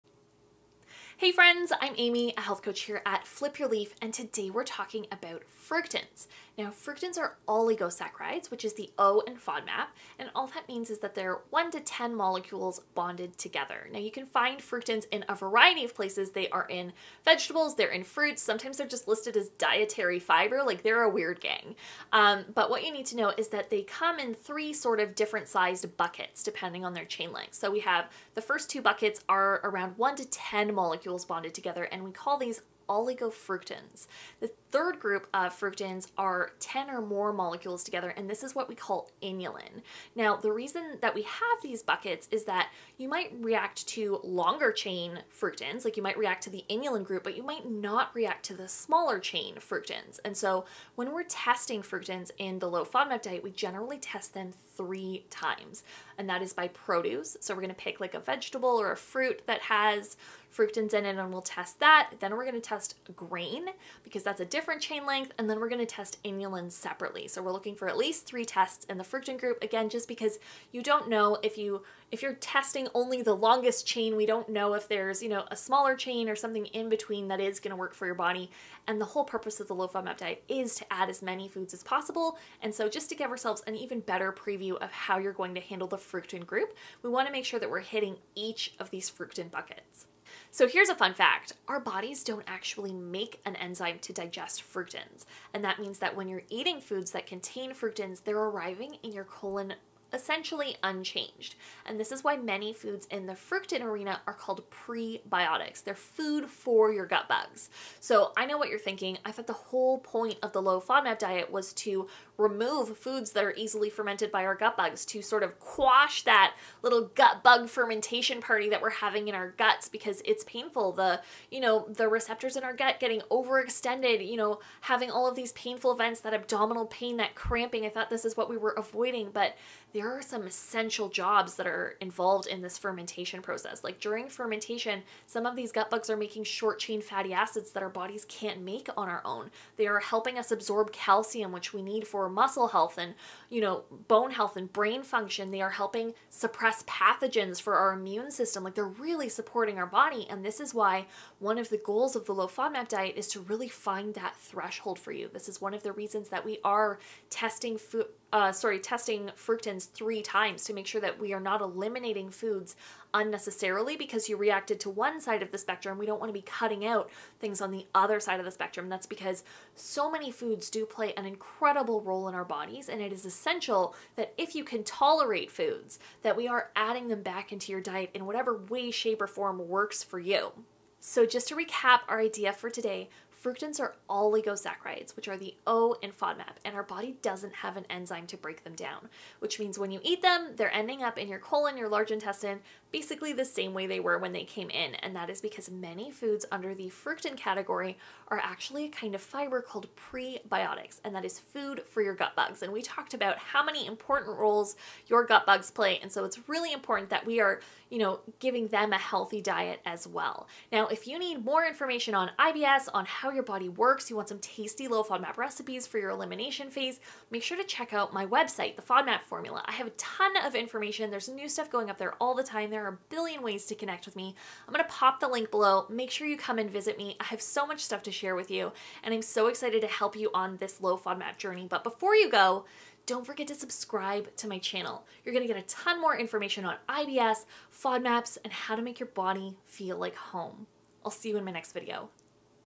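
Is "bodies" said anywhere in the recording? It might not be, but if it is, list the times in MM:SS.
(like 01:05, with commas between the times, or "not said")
01:31, 02:17, 02:52.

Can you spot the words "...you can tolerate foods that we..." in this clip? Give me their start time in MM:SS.
02:54.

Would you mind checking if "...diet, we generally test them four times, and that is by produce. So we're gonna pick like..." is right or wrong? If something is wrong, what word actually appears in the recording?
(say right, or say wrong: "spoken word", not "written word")
wrong: "three", not "four".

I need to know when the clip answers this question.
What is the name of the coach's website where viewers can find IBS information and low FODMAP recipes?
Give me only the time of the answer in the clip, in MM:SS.
03:38.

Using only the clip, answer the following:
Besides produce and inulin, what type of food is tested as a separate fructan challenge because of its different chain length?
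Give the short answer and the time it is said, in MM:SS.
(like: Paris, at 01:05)
grain, at 01:02.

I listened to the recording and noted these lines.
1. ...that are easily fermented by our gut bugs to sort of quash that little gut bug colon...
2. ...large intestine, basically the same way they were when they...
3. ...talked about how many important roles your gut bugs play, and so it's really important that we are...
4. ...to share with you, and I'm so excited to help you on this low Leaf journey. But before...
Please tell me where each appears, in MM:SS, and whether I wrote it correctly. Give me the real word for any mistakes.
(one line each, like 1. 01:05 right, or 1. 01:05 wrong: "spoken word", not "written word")
1. 01:53 wrong: "fermentation", not "colon"
2. 03:11 right
3. 03:22 right
4. 03:48 wrong: "FODMAP", not "Leaf".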